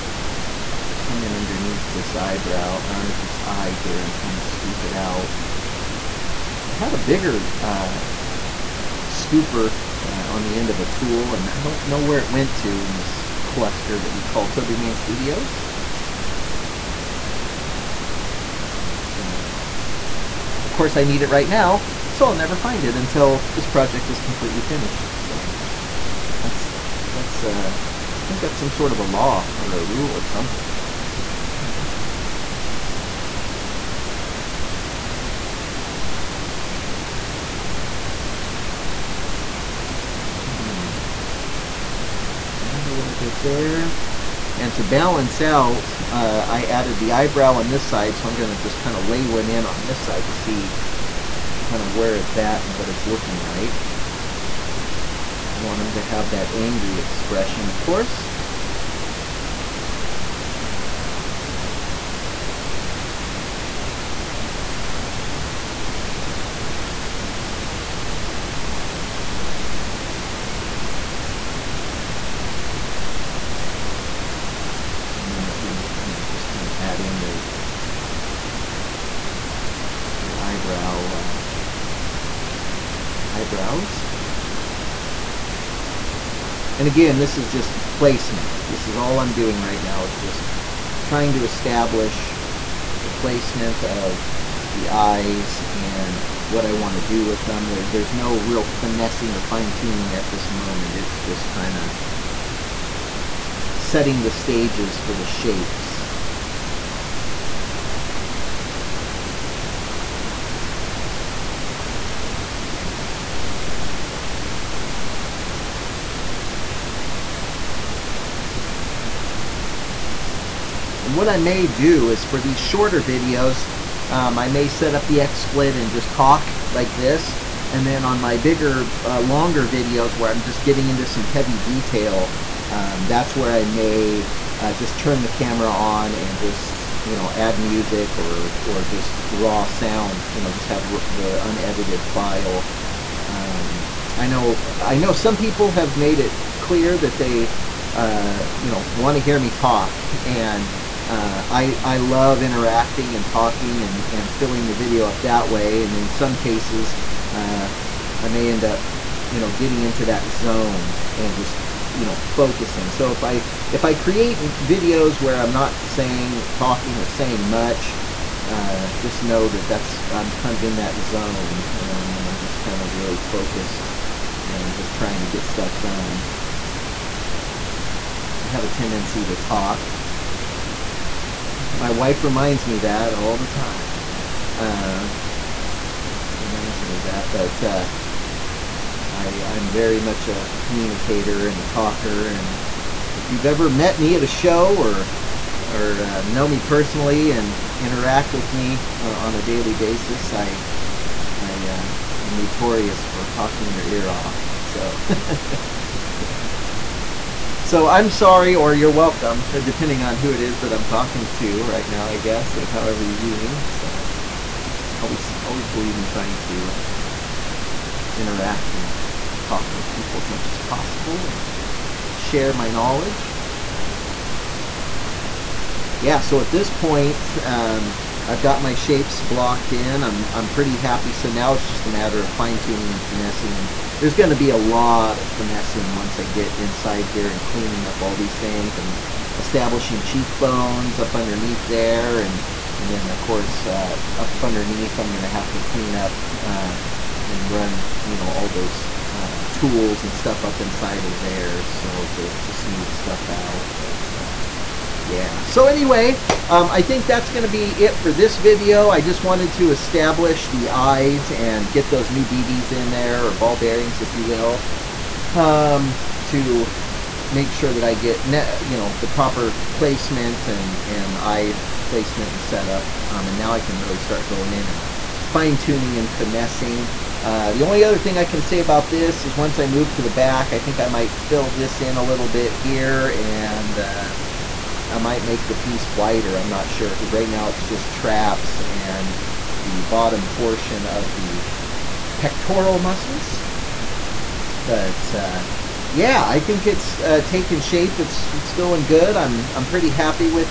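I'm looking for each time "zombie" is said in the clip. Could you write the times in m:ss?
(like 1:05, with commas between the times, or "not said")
not said.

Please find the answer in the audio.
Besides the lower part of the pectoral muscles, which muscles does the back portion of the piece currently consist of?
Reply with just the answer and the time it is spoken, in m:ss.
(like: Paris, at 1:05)
Traps, at 4:47.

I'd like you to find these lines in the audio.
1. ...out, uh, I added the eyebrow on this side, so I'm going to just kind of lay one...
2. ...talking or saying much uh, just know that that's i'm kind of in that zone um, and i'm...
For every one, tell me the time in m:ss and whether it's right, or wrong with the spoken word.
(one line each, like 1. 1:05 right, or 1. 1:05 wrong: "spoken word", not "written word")
1. 0:45 right
2. 2:46 right.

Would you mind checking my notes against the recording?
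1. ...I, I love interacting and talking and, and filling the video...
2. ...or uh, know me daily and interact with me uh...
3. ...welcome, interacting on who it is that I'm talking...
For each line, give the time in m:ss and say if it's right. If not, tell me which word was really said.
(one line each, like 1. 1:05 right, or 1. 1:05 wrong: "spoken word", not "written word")
1. 2:31 right
2. 3:15 wrong: "personally", not "daily"
3. 3:28 wrong: "depending", not "interacting".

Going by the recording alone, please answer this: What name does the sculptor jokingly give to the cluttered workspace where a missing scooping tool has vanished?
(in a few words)
Toby Wayne Studios.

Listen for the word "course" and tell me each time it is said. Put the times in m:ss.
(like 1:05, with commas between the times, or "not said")
0:20, 0:57, 4:03.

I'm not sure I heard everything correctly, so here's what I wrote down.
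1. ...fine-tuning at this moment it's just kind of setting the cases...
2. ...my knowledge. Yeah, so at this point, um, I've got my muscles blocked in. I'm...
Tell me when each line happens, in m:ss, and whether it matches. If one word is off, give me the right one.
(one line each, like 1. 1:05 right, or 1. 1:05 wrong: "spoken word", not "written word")
1. 1:39 wrong: "stages", not "cases"
2. 3:42 wrong: "shapes", not "muscles".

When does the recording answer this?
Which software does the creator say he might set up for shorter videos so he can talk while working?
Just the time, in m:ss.
2:05.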